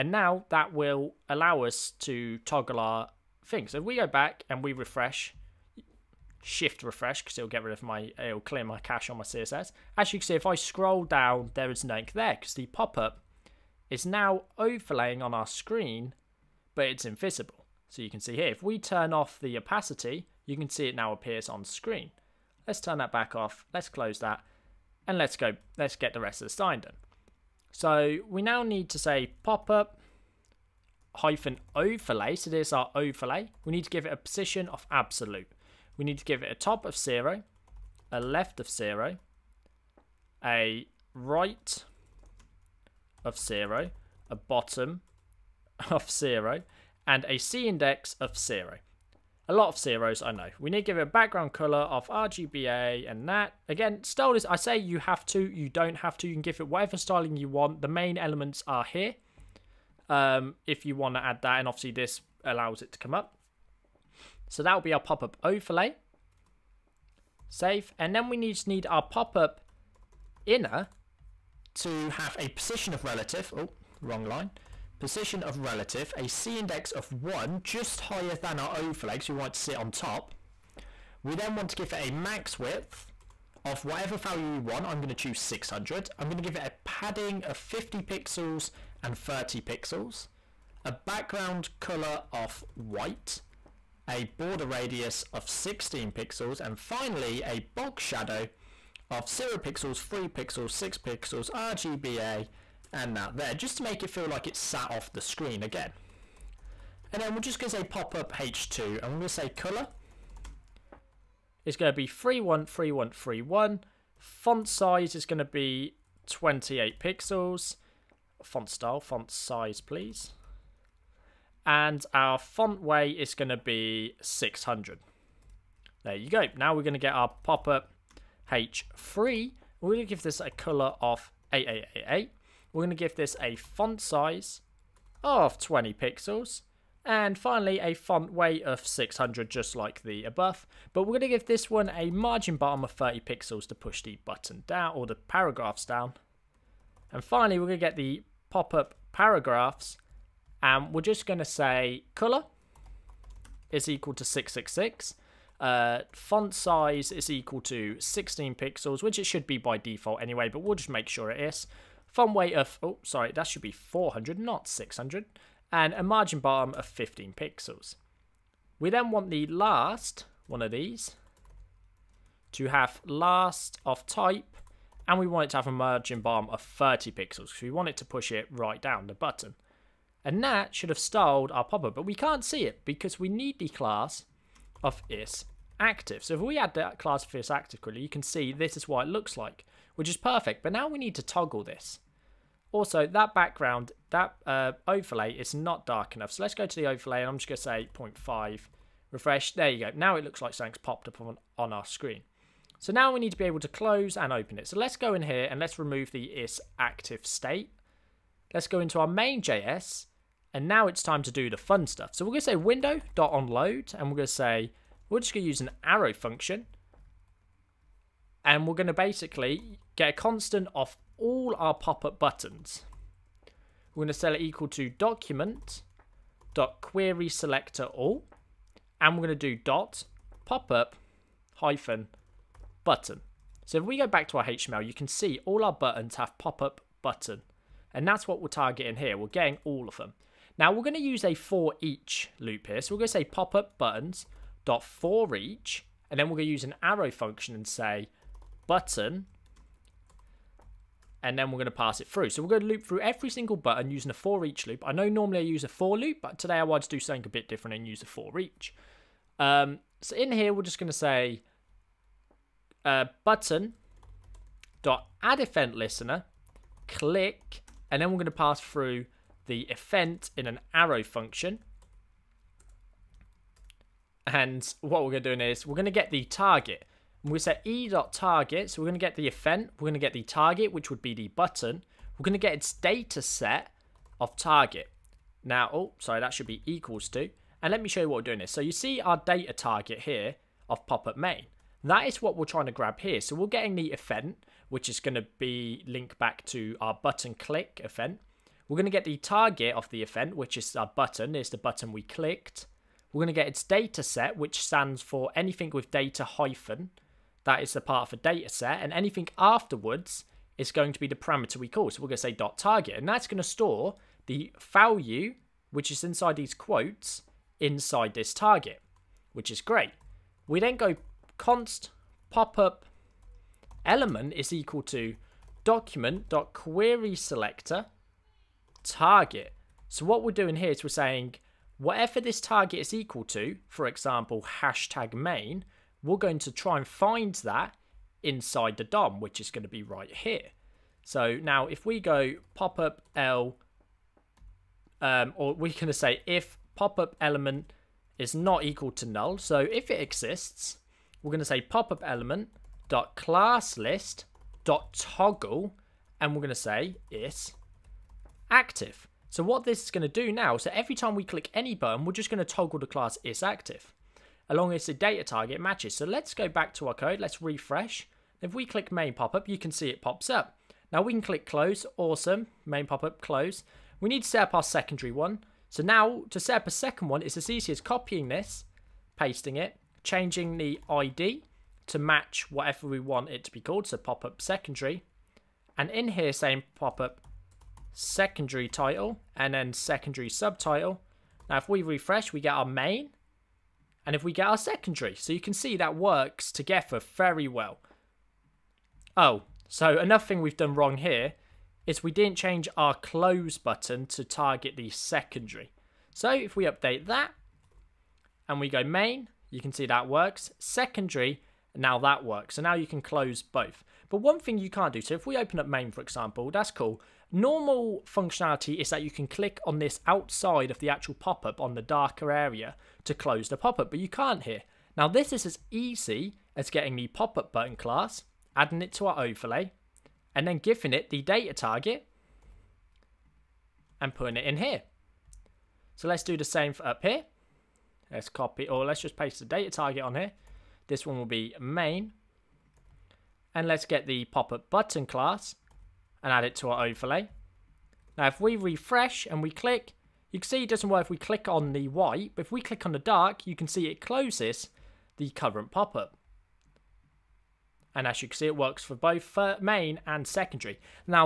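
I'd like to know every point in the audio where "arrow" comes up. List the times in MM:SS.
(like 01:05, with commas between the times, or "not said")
03:35, 04:06, 04:30.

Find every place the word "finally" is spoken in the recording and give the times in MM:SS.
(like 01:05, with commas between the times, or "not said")
01:36, 02:17, 02:27.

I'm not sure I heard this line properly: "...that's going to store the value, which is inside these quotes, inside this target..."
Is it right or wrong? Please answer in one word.
right.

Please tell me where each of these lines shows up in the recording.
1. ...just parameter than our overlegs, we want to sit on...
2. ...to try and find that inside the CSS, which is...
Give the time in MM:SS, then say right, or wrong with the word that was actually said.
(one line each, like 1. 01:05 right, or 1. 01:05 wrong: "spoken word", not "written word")
1. 01:17 wrong: "higher", not "parameter"
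2. 05:36 wrong: "DOM", not "CSS".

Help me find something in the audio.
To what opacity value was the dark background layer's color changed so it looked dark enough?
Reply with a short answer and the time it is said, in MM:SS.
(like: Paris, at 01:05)
0.5, at 03:17.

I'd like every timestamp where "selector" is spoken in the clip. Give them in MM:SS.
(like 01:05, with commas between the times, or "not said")
03:47, 05:27.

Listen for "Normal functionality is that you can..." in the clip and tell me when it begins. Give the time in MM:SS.
06:57.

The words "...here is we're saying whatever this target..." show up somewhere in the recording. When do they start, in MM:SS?
05:30.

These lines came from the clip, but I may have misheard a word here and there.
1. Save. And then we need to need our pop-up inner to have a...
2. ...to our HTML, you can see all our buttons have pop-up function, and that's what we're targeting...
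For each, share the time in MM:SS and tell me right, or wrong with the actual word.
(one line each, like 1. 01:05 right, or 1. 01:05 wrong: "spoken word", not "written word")
1. 01:07 right
2. 03:54 wrong: "button", not "function".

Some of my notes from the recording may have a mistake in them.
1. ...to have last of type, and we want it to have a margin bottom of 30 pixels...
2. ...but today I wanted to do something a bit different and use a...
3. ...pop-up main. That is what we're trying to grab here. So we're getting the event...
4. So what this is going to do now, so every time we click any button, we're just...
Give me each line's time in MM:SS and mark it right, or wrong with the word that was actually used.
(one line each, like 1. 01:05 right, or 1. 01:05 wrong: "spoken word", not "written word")
1. 02:52 right
2. 04:16 right
3. 04:50 right
4. 05:59 right.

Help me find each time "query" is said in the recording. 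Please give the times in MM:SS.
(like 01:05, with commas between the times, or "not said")
03:46, 05:26.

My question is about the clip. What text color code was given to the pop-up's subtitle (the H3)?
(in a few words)
8888.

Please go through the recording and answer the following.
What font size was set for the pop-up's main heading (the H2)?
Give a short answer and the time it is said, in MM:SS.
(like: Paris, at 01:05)
28 pixels, at 01:56.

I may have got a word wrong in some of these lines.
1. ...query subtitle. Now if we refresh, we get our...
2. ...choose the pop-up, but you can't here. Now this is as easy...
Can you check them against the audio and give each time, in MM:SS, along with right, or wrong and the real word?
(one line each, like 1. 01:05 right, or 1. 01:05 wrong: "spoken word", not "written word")
1. 06:29 wrong: "secondary", not "query"
2. 07:03 wrong: "close", not "choose".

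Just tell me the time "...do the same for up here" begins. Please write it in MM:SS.
07:16.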